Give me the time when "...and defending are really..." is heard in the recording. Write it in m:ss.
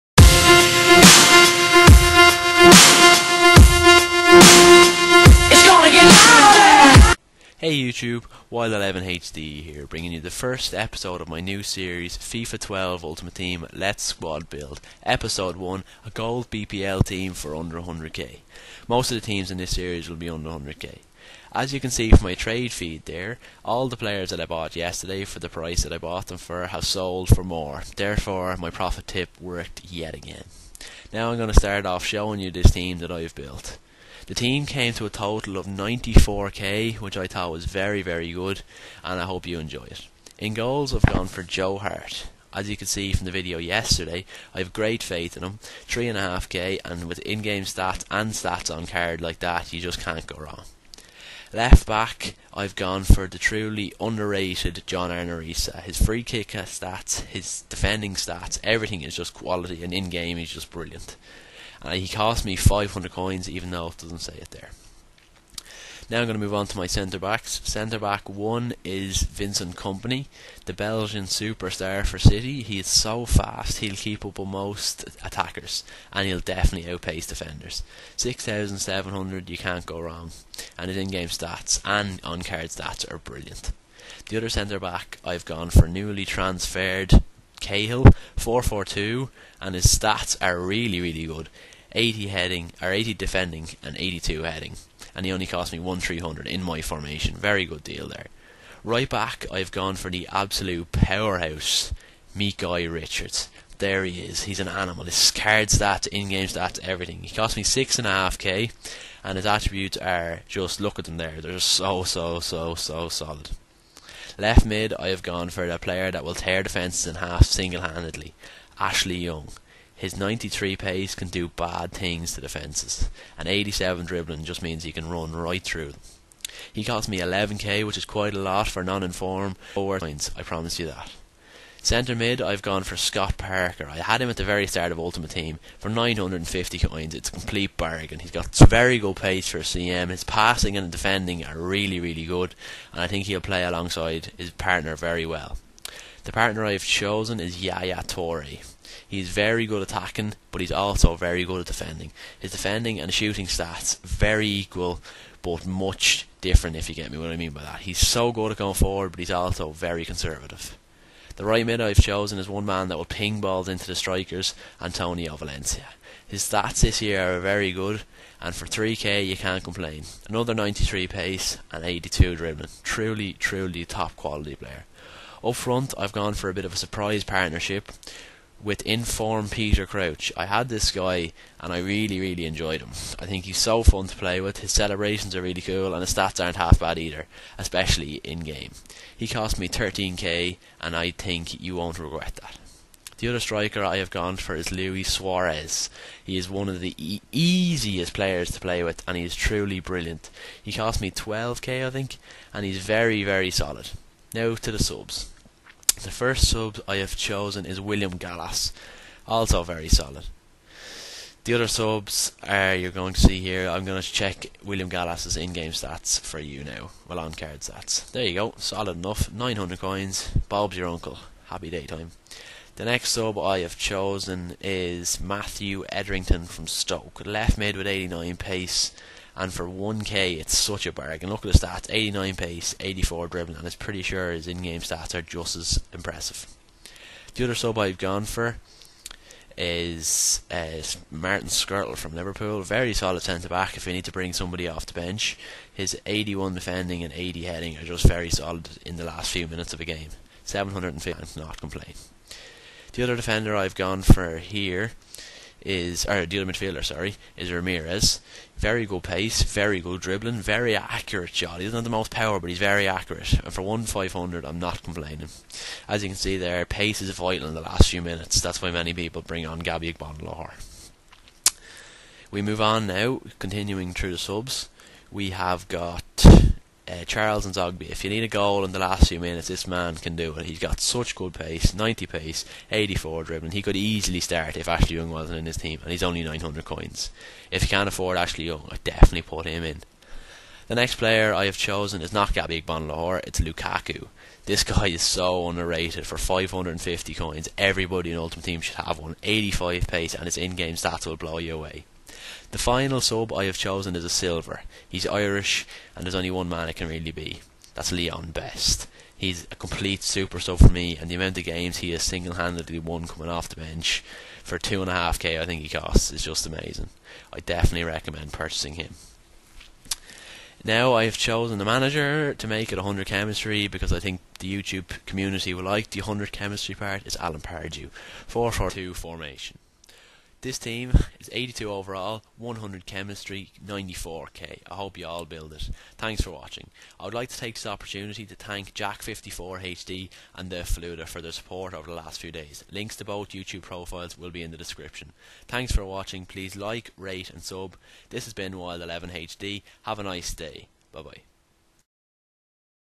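2:20.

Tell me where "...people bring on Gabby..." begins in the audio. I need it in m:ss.
4:28.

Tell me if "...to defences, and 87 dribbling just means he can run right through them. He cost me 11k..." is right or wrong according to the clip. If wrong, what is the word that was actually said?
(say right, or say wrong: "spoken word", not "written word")
right.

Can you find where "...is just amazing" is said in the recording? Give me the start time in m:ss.
5:16.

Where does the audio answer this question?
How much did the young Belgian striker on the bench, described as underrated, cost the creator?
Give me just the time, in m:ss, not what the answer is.
4:56.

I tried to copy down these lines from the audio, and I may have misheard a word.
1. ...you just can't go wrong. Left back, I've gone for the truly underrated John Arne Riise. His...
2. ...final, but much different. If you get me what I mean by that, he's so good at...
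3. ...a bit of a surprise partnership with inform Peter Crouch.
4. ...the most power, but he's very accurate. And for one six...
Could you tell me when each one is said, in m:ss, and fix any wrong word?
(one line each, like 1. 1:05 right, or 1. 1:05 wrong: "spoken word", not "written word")
1. 0:49 right
2. 2:34 wrong: "equal", not "final"
3. 2:56 right
4. 4:21 wrong: "five", not "six".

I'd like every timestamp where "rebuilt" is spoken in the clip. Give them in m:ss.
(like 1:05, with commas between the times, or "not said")
not said.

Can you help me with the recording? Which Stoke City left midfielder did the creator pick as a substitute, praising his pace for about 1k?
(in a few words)
Matthew Etherington.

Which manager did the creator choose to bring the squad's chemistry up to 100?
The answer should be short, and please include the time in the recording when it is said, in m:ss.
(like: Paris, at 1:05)
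Alan Pardew, at 5:27.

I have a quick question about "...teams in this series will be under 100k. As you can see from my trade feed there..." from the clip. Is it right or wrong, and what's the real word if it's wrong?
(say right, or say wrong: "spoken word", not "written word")
right.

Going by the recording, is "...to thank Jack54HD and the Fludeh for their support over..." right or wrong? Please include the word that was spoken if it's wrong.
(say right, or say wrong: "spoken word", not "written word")
right.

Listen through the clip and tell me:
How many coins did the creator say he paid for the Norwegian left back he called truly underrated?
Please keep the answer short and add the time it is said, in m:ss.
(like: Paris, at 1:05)
500 coins, at 1:02.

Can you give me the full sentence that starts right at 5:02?
The final sub I have chosen is a silver.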